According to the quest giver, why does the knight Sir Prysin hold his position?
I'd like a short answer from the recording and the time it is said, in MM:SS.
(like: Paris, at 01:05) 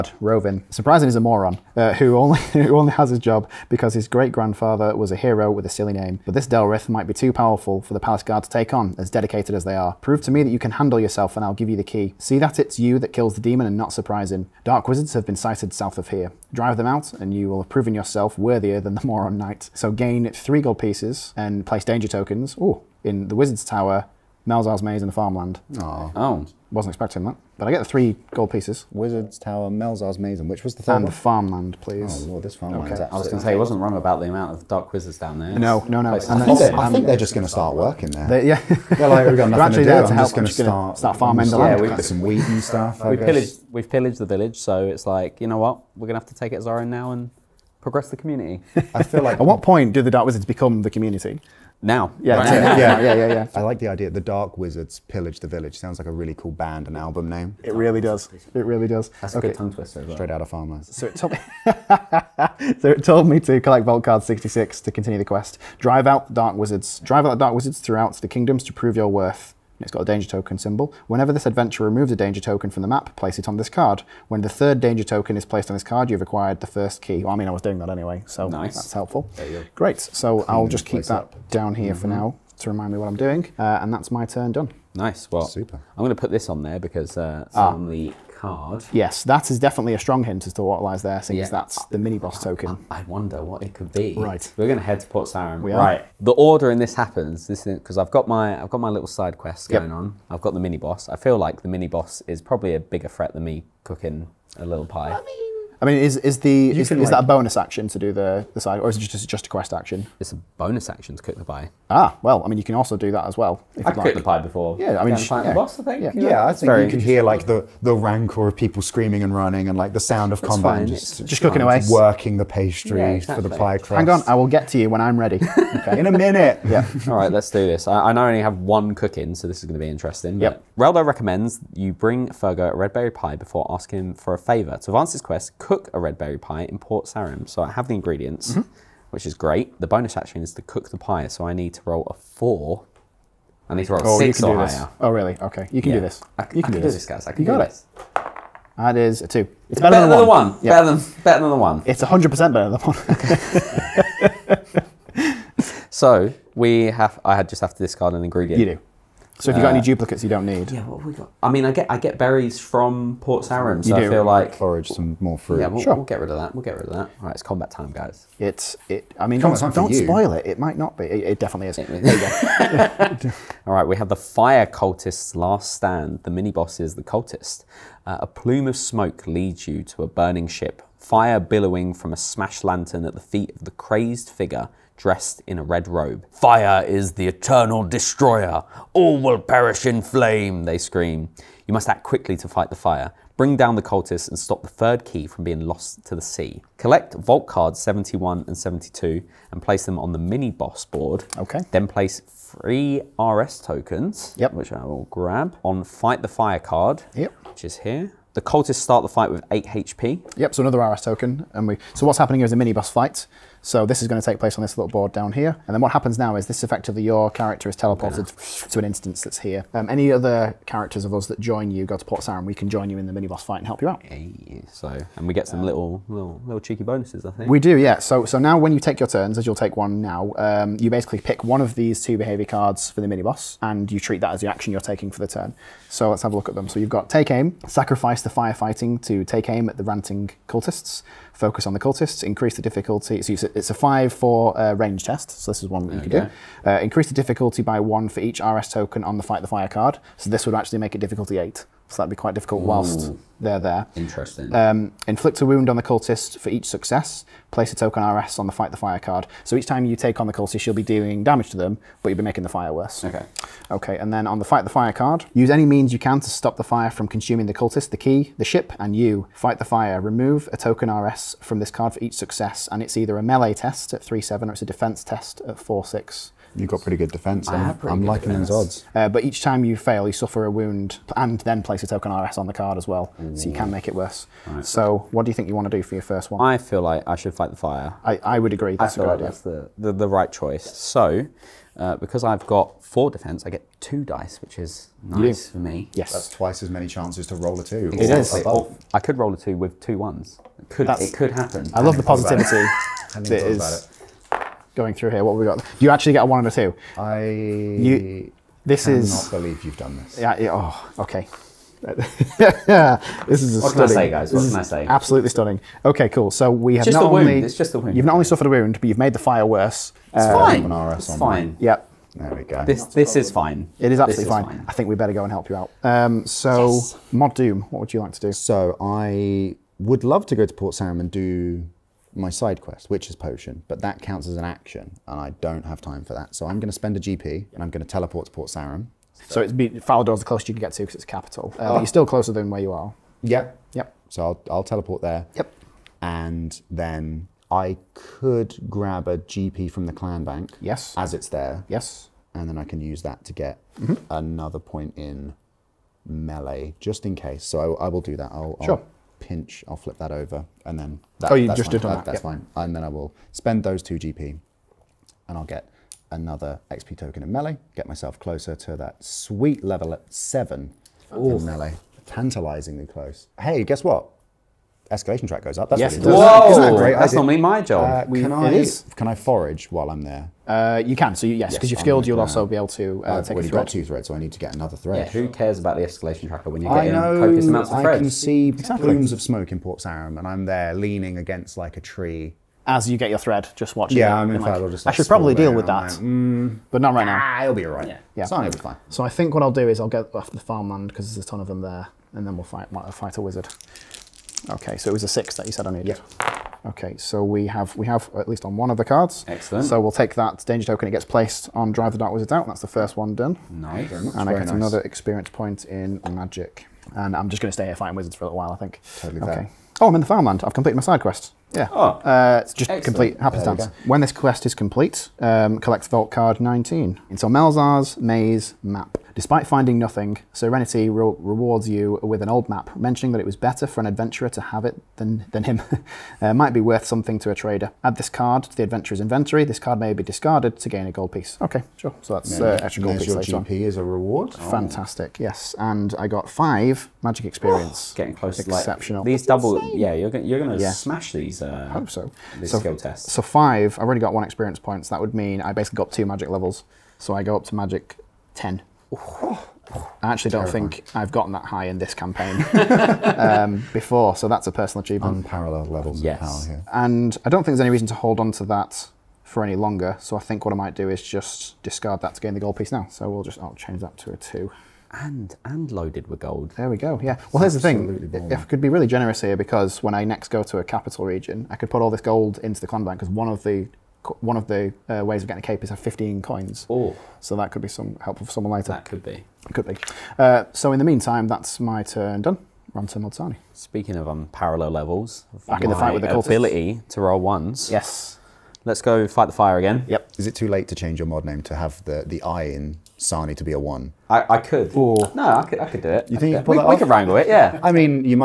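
His great-grandfather was a hero, at 00:04.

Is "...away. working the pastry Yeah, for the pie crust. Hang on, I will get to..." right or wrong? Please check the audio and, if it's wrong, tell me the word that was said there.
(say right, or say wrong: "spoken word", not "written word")
right.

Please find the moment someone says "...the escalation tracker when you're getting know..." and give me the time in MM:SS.
06:25.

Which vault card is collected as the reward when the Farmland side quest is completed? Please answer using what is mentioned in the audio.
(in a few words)
19.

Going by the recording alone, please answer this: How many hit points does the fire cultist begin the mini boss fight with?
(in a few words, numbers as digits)
8.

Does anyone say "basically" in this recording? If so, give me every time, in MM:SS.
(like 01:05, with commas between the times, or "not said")
03:50, 07:35.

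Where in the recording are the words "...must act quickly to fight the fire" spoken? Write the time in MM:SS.
03:11.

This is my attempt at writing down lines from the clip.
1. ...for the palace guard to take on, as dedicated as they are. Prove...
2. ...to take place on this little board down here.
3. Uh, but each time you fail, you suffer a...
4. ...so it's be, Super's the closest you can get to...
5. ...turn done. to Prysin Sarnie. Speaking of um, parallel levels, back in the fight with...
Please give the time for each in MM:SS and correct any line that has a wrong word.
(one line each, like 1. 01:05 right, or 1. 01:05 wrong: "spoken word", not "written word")
1. 00:07 right
2. 03:34 right
3. 04:38 right
4. 05:39 wrong: "Falador", not "Super"
5. 08:11 wrong: "Mod", not "Prysin".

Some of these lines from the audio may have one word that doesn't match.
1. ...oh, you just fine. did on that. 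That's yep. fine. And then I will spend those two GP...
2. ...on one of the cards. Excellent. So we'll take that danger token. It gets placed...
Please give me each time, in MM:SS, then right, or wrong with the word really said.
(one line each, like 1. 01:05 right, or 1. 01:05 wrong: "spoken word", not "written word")
1. 06:01 right
2. 06:48 right.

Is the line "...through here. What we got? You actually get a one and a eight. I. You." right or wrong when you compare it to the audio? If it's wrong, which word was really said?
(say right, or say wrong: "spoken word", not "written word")
wrong: "two", not "eight".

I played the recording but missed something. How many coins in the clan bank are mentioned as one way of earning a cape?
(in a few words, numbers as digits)
15.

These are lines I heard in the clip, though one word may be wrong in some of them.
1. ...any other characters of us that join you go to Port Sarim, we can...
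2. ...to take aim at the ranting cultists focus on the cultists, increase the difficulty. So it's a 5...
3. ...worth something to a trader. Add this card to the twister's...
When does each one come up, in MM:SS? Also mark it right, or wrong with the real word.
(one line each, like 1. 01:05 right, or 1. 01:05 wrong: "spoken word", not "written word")
1. 03:39 right
2. 03:59 right
3. 07:16 wrong: "adventurer", not "twister".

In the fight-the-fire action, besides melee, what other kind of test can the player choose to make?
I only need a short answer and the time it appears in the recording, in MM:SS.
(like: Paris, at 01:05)
Defense test, at 04:34.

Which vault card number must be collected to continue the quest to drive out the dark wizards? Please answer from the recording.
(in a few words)
66.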